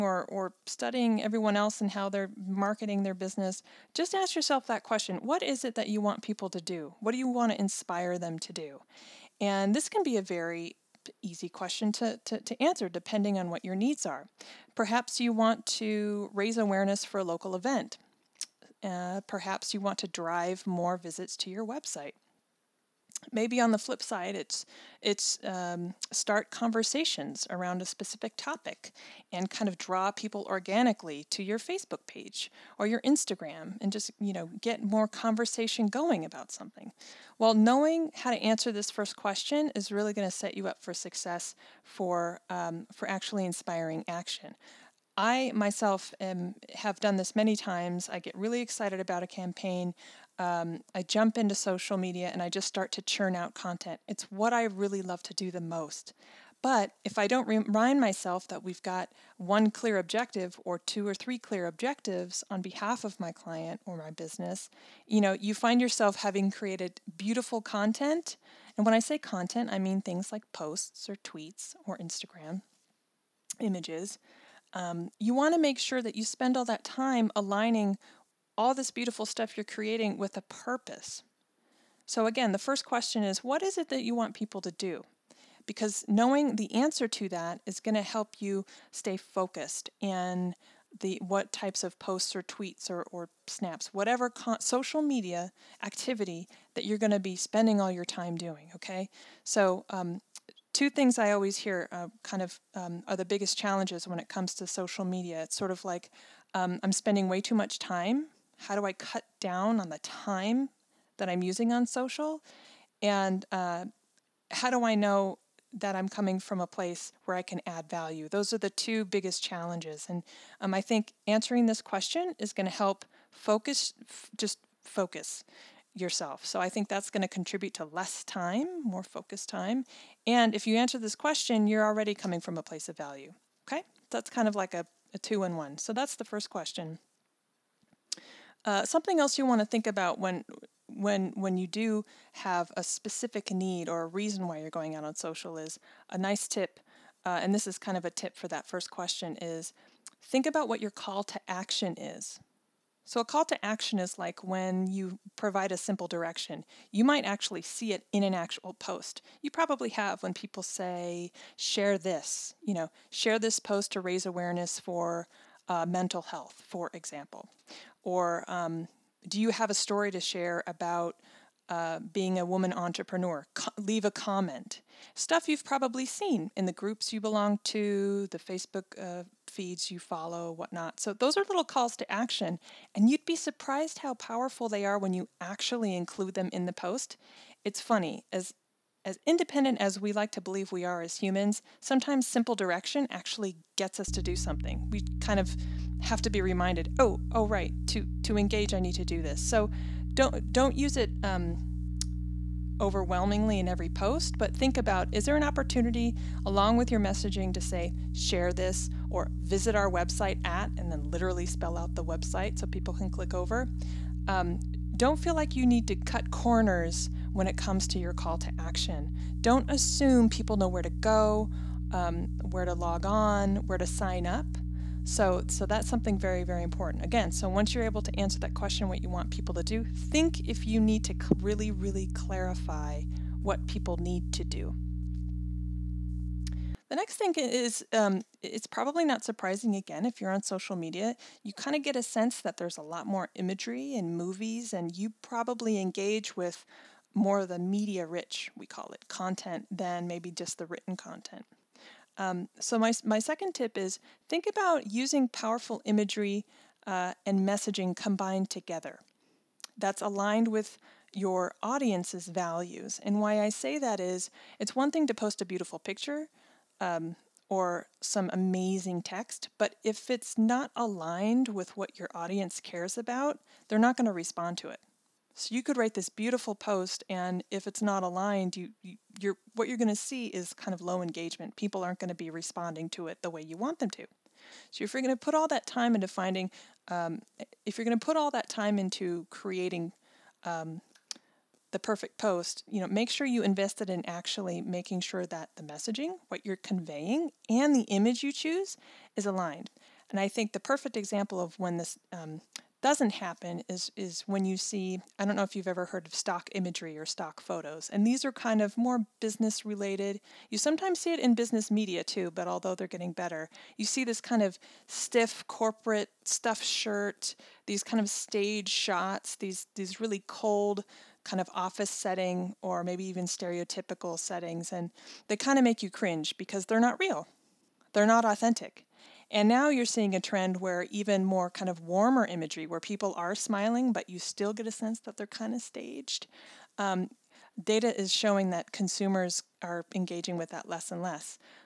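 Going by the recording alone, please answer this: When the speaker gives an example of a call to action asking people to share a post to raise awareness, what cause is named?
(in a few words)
mental health.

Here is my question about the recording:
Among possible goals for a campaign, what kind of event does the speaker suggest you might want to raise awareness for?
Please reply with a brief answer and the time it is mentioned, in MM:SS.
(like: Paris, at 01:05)
a local event, at 00:17.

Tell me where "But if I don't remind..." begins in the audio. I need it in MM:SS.
00:56.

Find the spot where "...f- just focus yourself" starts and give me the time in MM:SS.
02:04.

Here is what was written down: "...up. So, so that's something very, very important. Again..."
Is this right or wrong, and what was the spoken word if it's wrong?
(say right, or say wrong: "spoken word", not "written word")
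right.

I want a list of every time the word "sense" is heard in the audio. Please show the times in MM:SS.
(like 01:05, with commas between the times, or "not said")
04:02, 05:34.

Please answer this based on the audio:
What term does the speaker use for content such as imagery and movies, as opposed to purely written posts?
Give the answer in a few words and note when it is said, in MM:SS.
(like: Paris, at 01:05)
media rich, at 04:07.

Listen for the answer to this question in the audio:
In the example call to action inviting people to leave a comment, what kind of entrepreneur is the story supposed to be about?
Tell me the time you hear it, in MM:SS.
02:52.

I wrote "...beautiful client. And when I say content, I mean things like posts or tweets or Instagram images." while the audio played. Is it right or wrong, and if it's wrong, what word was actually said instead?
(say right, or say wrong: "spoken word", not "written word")
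wrong: "content", not "client".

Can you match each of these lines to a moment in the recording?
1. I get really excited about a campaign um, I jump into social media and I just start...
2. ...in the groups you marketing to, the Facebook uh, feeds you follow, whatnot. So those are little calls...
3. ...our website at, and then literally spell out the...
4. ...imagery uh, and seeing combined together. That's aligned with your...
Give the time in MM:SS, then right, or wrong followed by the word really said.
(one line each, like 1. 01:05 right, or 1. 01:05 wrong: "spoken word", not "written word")
1. 00:48 right
2. 02:56 wrong: "belong", not "marketing"
3. 03:29 right
4. 04:15 wrong: "messaging", not "seeing".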